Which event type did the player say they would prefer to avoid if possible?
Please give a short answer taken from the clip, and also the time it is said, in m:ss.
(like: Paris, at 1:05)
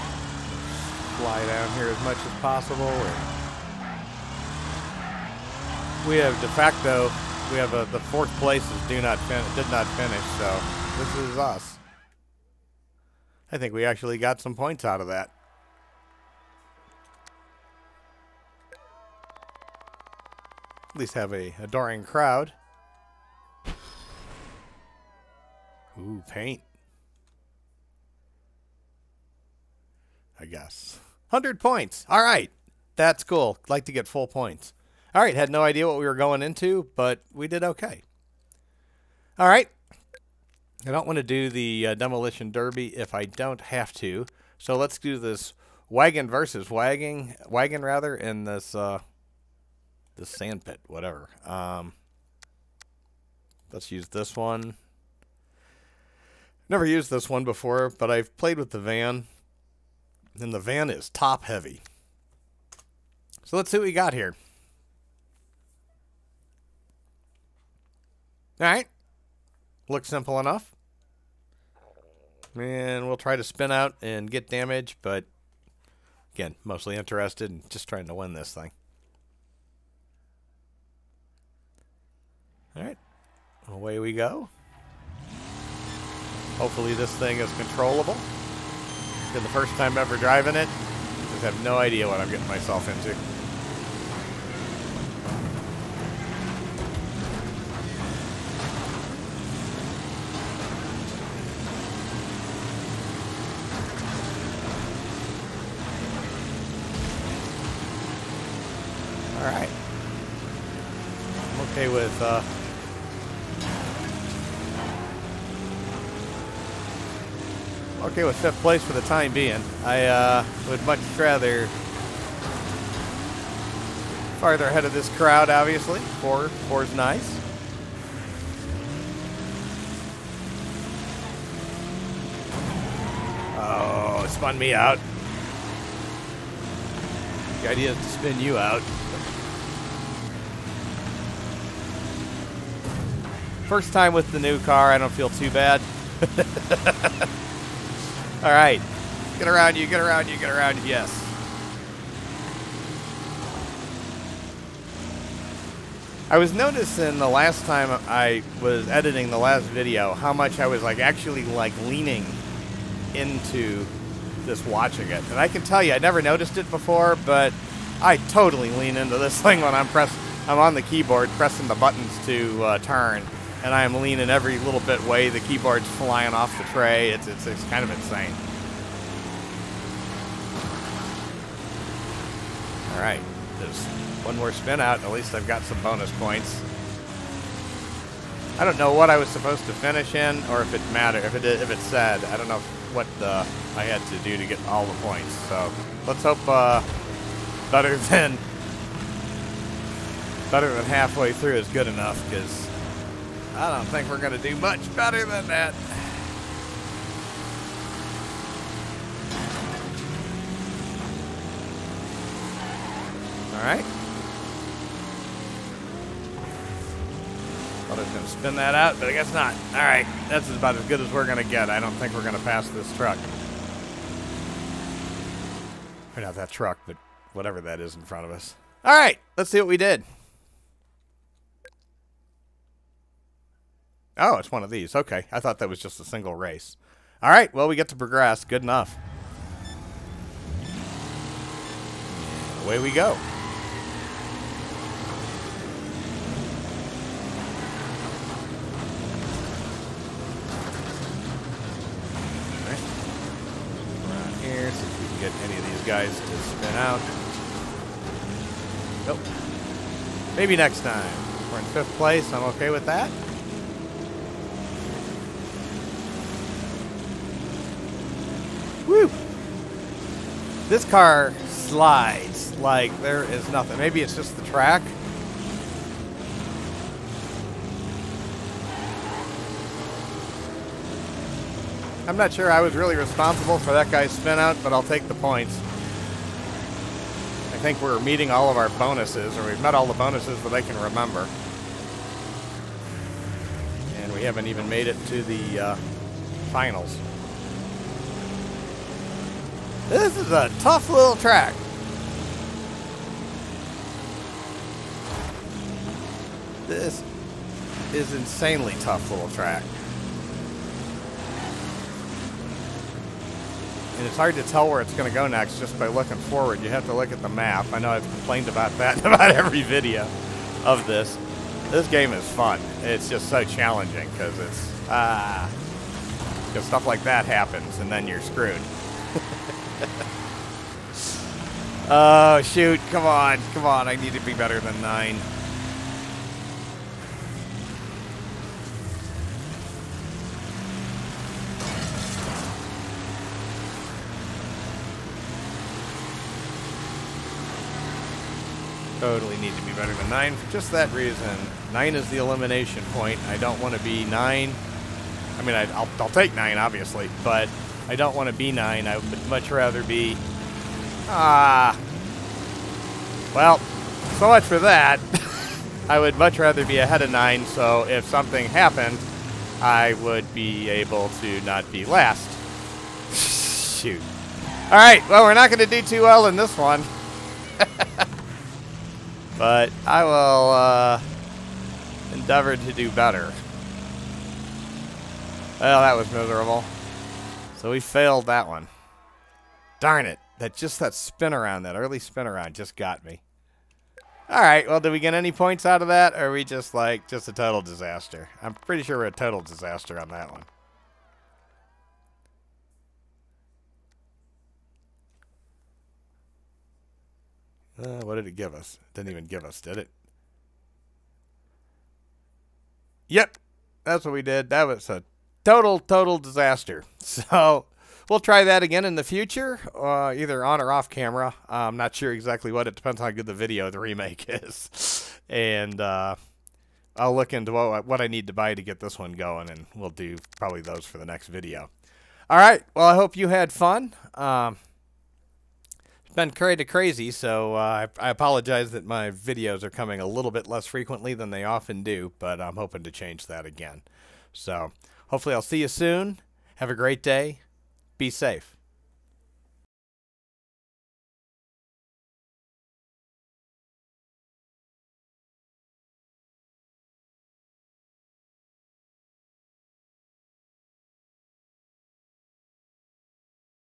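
Demolition Derby, at 0:41.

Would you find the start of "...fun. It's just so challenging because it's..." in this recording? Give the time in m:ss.
5:22.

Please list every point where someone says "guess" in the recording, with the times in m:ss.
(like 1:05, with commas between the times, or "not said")
0:30, 3:39.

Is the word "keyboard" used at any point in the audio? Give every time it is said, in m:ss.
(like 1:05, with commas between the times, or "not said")
2:50, 2:55.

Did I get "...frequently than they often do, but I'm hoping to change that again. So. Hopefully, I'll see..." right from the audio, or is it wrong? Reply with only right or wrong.
right.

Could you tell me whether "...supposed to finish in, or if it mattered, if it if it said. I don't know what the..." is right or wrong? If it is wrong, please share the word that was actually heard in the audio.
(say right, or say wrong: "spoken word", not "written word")
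right.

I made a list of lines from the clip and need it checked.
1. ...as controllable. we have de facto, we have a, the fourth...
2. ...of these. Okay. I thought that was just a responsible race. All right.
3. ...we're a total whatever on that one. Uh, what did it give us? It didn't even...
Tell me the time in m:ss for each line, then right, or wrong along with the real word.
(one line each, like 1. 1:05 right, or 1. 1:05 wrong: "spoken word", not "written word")
1. 0:02 wrong: "possible", not "controllable"
2. 3:54 wrong: "single", not "responsible"
3. 6:38 wrong: "disaster", not "whatever".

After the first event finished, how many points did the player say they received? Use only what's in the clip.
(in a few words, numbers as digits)
100.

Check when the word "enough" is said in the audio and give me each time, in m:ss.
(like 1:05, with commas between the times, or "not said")
1:10, 3:21, 3:58.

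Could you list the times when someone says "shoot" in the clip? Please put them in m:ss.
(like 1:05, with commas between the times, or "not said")
5:32, 6:13.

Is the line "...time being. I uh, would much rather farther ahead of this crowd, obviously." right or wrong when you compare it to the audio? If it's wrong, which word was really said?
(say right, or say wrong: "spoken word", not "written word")
right.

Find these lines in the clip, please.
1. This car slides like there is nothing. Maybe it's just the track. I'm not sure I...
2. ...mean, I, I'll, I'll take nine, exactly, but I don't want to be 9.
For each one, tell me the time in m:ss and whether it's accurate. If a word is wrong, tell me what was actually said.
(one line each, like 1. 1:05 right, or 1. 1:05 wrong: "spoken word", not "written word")
1. 4:30 right
2. 5:55 wrong: "obviously", not "exactly".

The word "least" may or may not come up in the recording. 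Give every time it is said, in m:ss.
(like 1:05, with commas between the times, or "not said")
0:20, 3:05.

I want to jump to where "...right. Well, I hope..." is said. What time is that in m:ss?
7:12.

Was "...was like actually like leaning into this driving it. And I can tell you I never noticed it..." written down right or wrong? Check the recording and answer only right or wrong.
wrong.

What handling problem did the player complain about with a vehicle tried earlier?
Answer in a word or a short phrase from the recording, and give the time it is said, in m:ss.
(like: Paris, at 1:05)
Top heavy, at 1:01.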